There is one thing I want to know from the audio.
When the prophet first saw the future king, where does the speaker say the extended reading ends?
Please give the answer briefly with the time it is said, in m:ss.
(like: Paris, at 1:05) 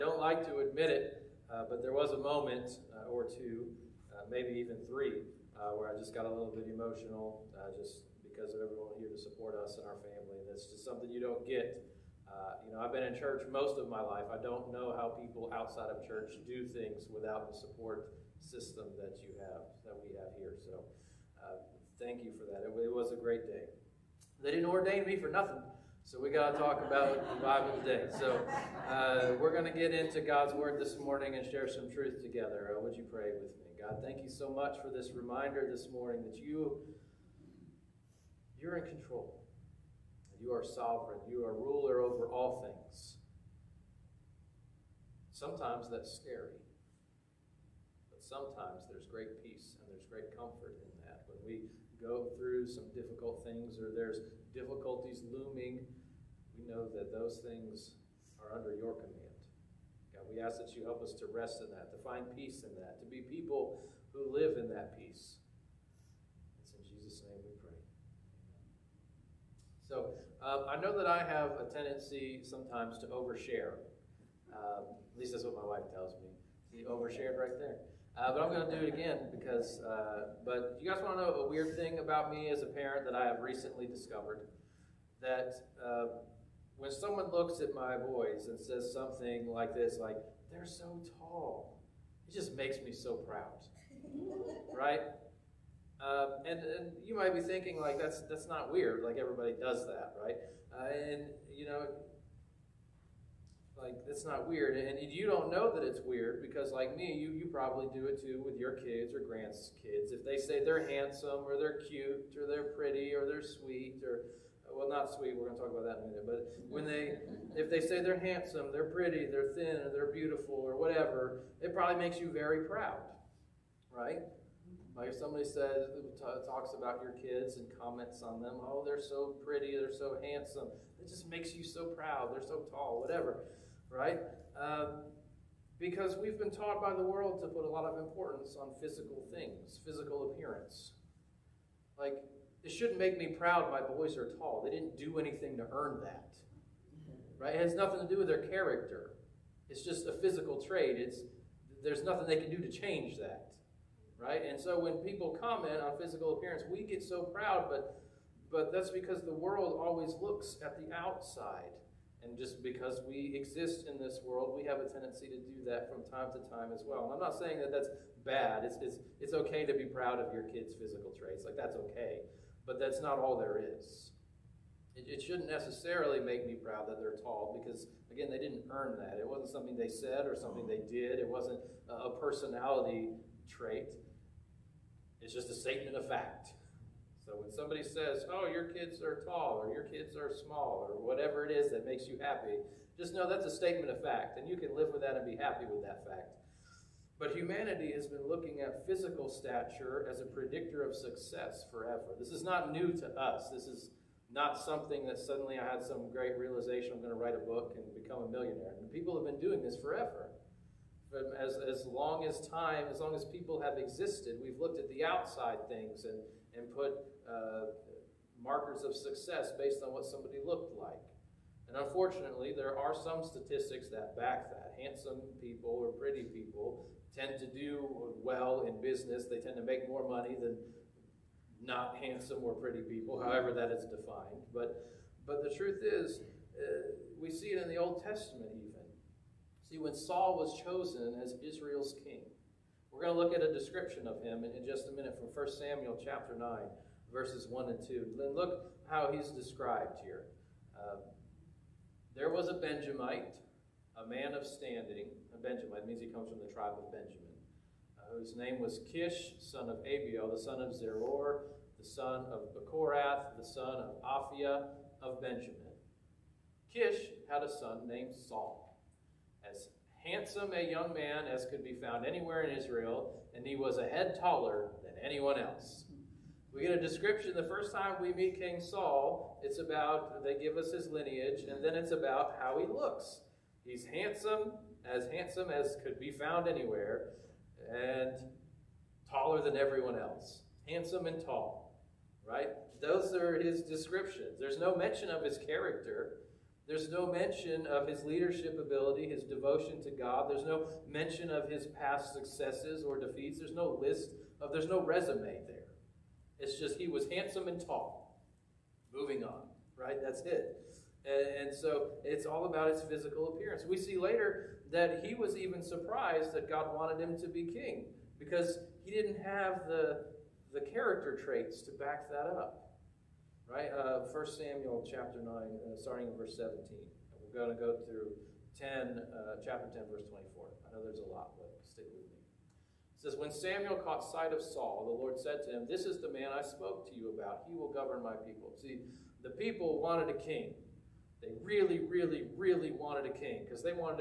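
Chapter 10, verse 24, at 5:29.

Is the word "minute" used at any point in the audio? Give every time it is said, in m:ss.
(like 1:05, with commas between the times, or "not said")
1:56, 4:04.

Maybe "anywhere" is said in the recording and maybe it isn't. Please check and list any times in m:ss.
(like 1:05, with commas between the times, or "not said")
4:32, 4:46.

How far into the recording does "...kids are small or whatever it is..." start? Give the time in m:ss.
3:09.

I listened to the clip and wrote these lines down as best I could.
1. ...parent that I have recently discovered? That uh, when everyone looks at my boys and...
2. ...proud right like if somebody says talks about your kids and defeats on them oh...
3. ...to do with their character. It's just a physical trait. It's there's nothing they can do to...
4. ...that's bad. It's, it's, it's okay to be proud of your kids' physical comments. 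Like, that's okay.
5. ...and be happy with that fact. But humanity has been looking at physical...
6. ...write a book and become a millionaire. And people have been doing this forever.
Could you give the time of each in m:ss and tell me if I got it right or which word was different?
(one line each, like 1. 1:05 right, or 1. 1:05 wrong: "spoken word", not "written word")
1. 1:22 wrong: "someone", not "everyone"
2. 2:02 wrong: "comments", not "defeats"
3. 2:28 right
4. 2:47 wrong: "traits", not "comments"
5. 3:15 right
6. 3:27 right.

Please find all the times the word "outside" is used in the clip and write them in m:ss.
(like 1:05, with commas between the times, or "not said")
0:15, 2:40, 3:35.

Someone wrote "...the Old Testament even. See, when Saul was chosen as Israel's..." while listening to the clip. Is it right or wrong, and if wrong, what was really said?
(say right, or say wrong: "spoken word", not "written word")
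right.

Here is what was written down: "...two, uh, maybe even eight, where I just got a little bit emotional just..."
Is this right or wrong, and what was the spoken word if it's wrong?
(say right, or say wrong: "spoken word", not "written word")
wrong: "three", not "eight".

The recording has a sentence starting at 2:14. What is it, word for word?
Uh, because we've been taught by the world to put a lot of importance on physical things, physical appearance.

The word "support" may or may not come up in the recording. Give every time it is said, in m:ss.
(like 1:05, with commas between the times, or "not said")
0:09, 0:17.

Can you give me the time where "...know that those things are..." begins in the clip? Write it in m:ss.
0:56.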